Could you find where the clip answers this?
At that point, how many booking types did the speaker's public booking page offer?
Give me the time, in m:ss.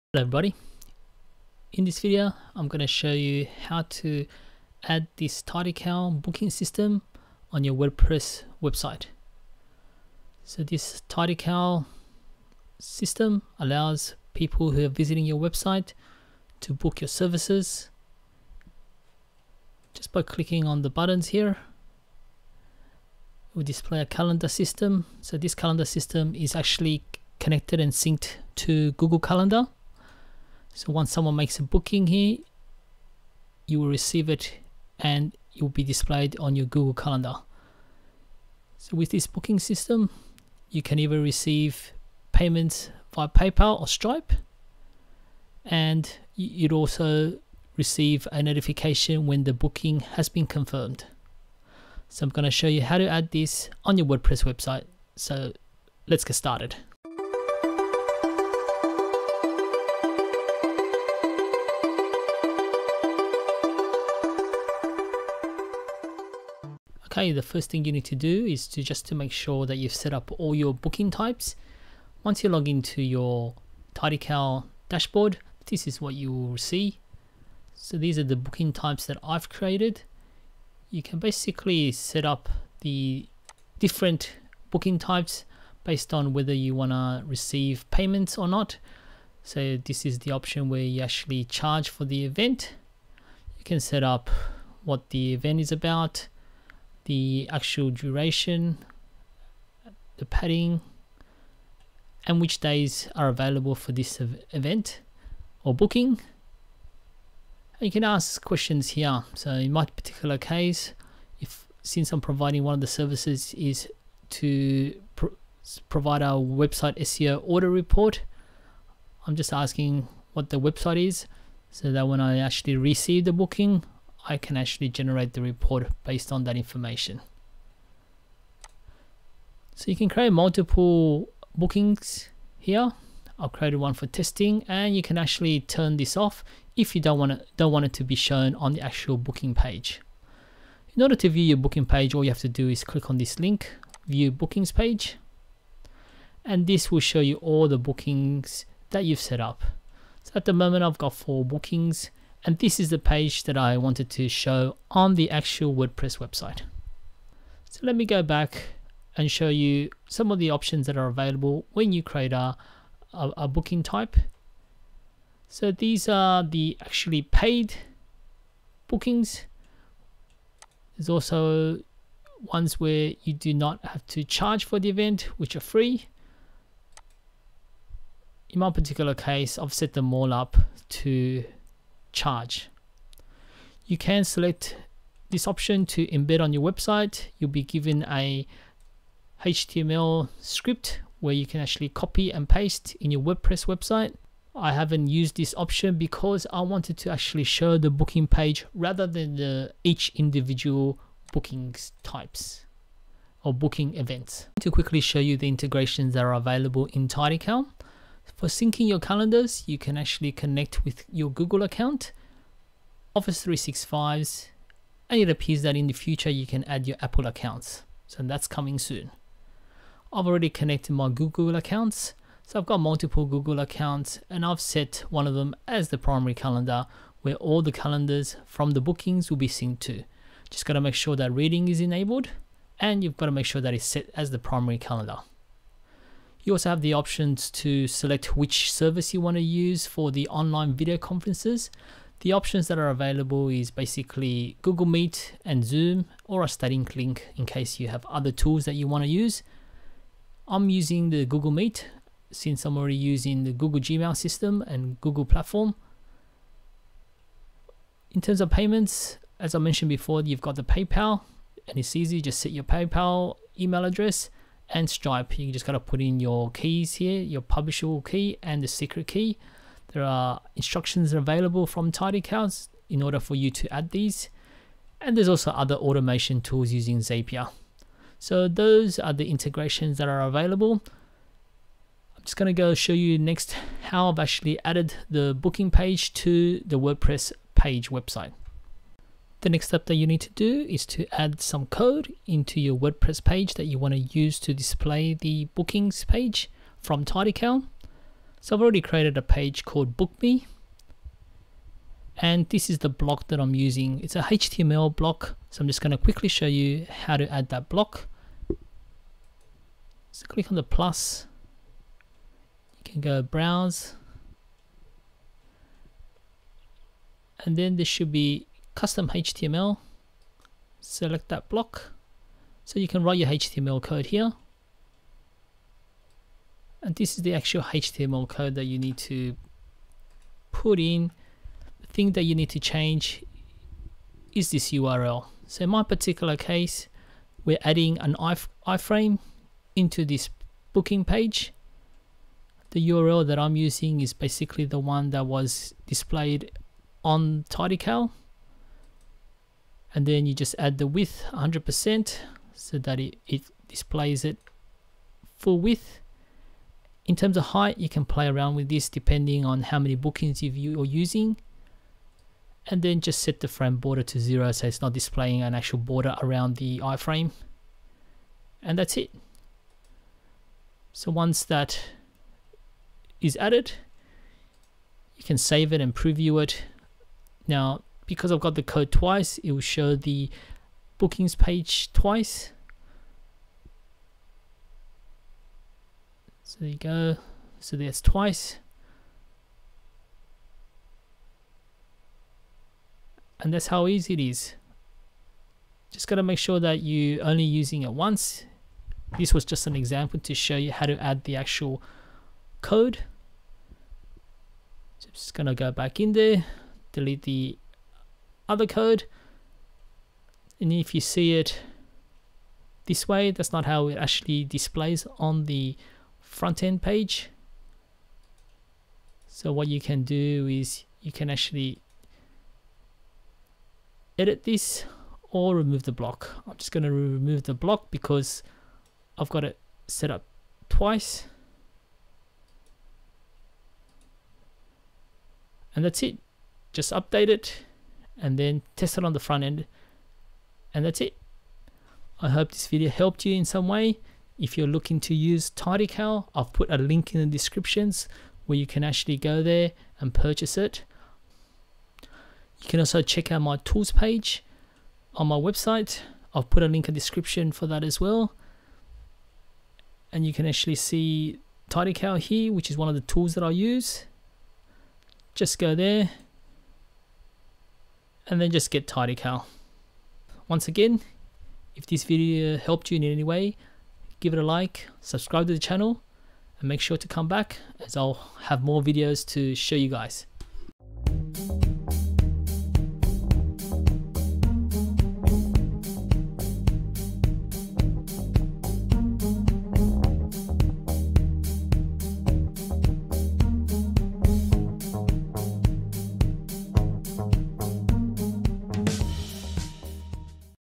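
2:31.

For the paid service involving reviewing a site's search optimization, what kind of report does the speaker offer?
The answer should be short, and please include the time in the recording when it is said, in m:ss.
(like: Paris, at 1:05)
website SEO audit report, at 1:56.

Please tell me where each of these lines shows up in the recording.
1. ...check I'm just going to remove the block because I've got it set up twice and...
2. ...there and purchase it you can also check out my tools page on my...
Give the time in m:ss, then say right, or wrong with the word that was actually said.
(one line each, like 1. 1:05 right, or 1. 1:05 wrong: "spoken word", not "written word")
1. 7:05 wrong: "block", not "check"
2. 7:29 right.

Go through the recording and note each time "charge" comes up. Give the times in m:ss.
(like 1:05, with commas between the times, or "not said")
1:31, 2:54, 3:02.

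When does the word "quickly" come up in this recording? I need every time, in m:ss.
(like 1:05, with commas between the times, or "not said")
3:24, 5:05.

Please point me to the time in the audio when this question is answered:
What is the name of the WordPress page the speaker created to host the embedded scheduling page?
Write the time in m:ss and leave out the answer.
4:59.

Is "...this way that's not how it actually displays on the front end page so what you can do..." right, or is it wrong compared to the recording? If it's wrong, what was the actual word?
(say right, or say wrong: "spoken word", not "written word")
right.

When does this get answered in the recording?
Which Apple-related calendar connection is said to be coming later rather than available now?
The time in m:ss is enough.
3:37.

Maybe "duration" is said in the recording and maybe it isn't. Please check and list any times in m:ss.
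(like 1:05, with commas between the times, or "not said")
1:37.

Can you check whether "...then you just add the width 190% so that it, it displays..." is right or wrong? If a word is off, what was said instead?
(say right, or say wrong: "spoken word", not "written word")
wrong: "100", not "190".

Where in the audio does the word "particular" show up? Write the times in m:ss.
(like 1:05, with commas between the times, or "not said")
1:49, 2:58, 5:35.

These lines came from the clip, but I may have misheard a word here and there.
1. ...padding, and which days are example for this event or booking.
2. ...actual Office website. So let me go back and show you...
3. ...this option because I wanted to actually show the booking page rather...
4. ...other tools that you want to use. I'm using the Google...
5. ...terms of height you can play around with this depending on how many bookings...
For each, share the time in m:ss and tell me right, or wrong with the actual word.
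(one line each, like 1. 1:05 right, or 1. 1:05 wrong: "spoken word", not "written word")
1. 1:40 wrong: "available", not "example"
2. 2:35 wrong: "WordPress", not "Office"
3. 3:15 right
4. 4:08 right
5. 5:57 right.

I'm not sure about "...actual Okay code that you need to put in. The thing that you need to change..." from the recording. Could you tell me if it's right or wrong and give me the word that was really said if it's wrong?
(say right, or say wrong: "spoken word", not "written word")
wrong: "HTML", not "Okay".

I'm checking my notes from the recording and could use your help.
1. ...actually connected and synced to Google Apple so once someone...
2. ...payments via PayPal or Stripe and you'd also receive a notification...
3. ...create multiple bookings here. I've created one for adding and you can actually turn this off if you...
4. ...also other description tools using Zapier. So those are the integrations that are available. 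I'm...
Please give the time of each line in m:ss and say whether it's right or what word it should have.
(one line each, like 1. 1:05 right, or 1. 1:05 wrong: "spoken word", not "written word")
1. 0:26 wrong: "Calendar", not "Apple"
2. 0:42 right
3. 2:10 wrong: "testing", not "adding"
4. 4:35 wrong: "automation", not "description".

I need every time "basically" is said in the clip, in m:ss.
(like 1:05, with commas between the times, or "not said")
1:21, 4:03, 5:44.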